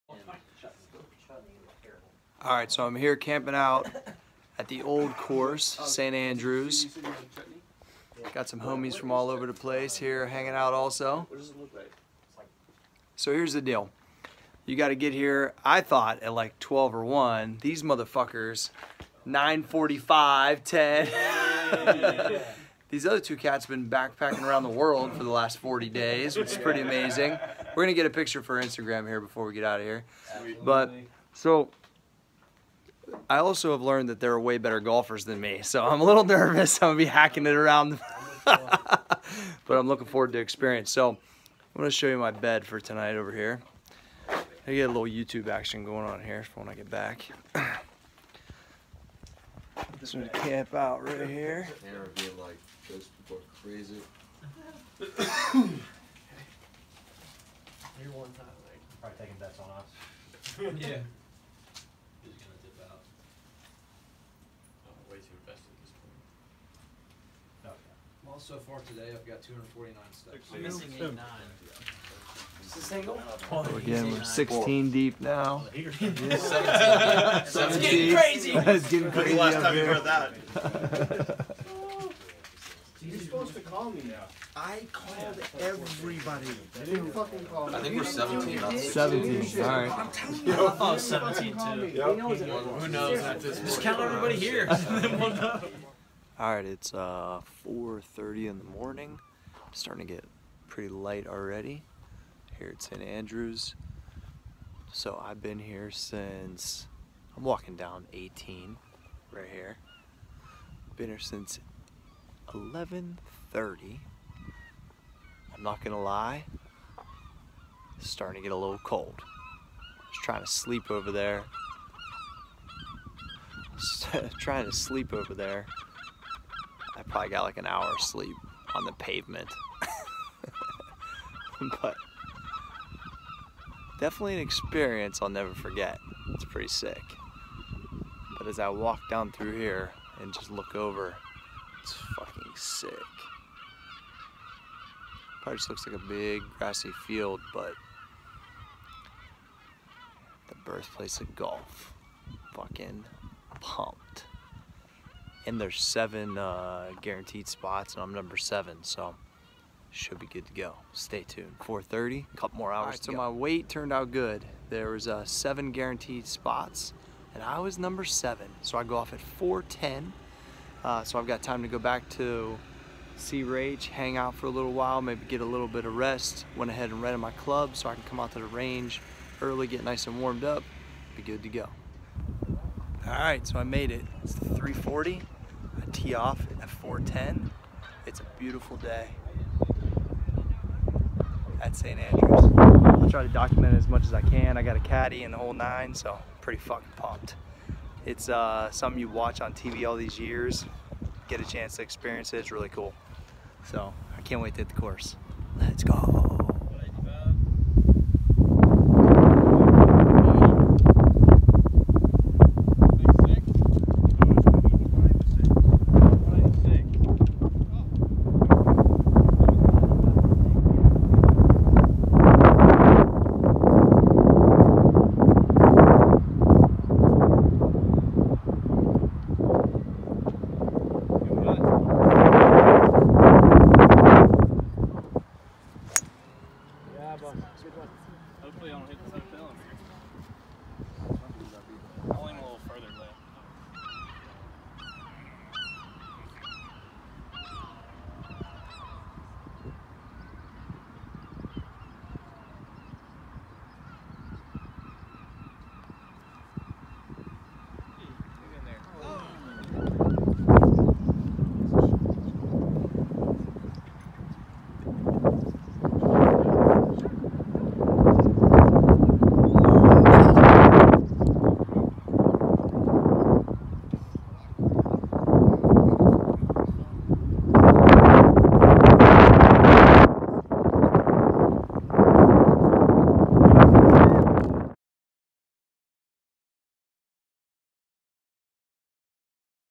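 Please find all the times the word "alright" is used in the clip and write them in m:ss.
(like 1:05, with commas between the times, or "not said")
1:29, 1:36.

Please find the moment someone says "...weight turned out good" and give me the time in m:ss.
2:43.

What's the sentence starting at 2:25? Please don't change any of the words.
Probably just looks like a big grassy field, but the birthplace of golf.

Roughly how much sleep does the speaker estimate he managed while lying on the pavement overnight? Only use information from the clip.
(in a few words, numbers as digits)
an hour.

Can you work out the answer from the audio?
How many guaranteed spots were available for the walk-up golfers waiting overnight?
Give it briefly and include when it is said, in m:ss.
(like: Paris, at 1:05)
7, at 2:35.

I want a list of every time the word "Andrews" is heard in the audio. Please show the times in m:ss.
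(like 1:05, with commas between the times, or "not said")
0:06, 1:42, 3:11.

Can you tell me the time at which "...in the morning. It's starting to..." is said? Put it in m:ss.
1:38.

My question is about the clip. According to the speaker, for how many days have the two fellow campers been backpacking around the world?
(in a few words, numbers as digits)
40.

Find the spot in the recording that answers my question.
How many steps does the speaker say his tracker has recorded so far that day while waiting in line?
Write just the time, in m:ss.
1:09.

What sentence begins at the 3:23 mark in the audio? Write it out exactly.
So I can't wait to hit the course.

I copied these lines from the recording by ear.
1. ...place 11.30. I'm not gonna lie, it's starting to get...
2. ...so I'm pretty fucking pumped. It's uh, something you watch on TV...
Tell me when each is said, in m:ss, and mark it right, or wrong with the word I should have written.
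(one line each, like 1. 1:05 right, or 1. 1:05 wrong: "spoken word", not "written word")
1. 1:51 wrong: "since", not "place"
2. 3:15 right.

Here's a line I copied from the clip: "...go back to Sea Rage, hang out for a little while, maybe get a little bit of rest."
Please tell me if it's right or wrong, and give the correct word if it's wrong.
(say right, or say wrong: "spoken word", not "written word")
right.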